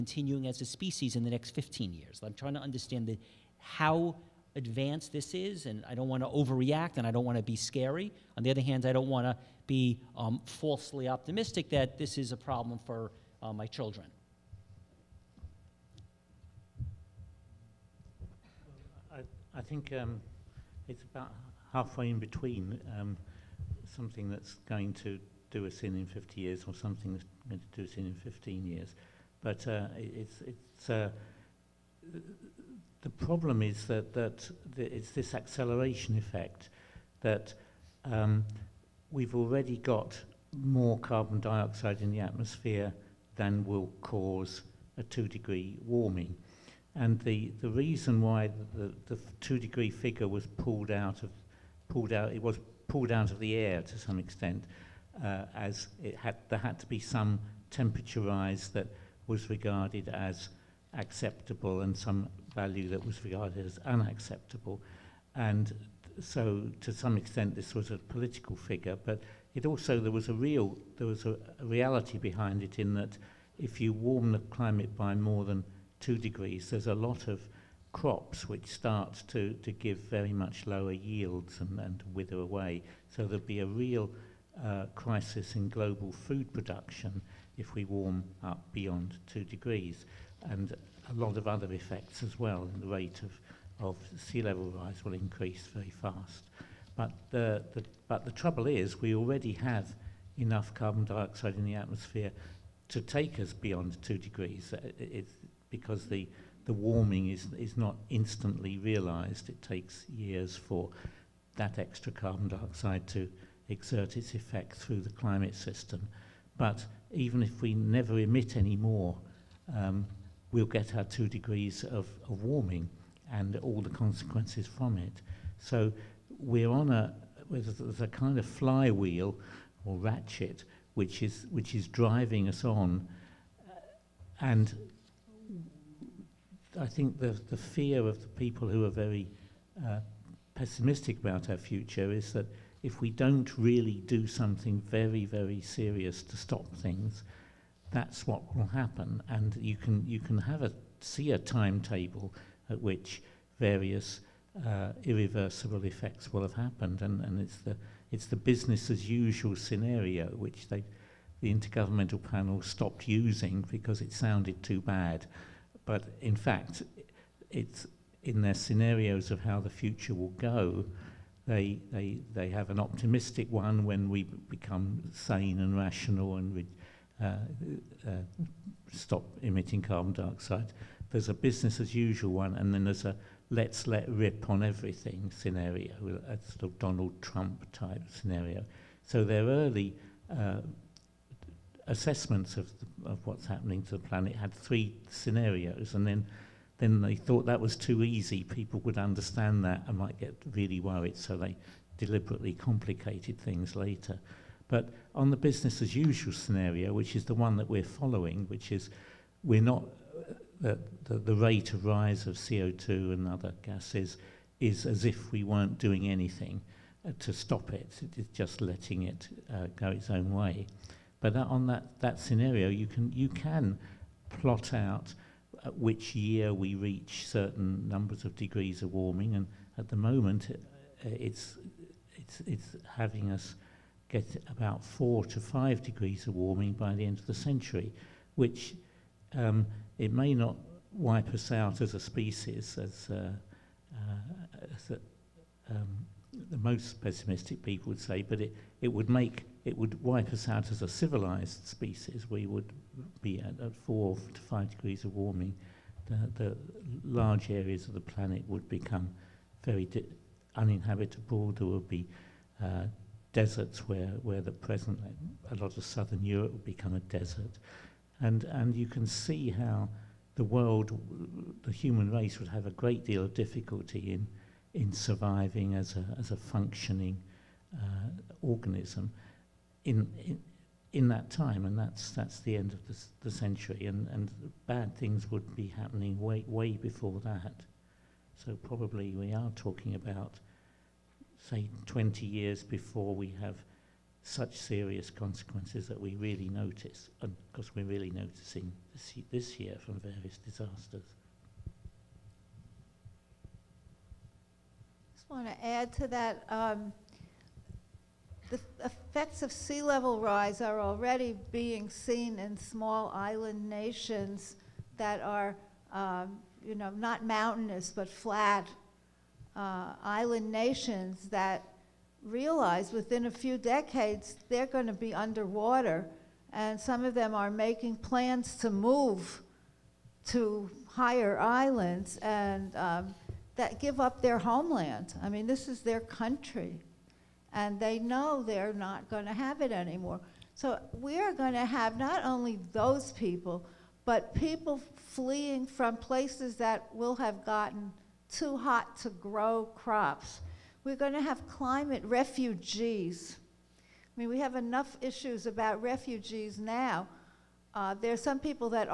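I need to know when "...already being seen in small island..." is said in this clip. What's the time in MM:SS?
05:10.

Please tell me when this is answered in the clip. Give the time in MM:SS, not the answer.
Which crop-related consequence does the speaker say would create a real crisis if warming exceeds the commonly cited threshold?
01:25.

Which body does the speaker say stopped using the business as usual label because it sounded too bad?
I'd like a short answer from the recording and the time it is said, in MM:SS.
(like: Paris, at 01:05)
the intergovernmental panel, at 02:41.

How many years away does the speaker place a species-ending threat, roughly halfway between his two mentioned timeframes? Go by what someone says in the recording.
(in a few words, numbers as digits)
50 years.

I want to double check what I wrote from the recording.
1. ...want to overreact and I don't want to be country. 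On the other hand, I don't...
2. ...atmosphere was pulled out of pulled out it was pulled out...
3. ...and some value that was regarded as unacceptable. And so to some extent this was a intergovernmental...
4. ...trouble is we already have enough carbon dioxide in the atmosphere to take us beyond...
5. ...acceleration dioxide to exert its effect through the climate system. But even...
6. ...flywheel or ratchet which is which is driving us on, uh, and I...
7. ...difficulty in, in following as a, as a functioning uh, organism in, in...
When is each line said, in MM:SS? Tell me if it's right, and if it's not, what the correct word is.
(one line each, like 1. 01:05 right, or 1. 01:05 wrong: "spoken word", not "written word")
1. 00:06 wrong: "scary", not "country"
2. 00:49 wrong: "figure", not "atmosphere"
3. 01:01 wrong: "political", not "intergovernmental"
4. 01:38 right
5. 01:52 wrong: "carbon", not "acceleration"
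6. 02:08 right
7. 04:33 wrong: "surviving", not "following".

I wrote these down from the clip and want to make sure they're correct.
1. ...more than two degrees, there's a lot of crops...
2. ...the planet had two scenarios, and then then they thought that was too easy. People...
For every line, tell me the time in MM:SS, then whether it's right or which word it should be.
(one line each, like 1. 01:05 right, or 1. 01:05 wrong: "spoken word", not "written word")
1. 01:15 right
2. 03:13 wrong: "three", not "two".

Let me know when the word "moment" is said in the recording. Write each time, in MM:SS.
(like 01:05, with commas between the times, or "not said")
03:49.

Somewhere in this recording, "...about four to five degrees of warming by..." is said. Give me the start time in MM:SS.
03:54.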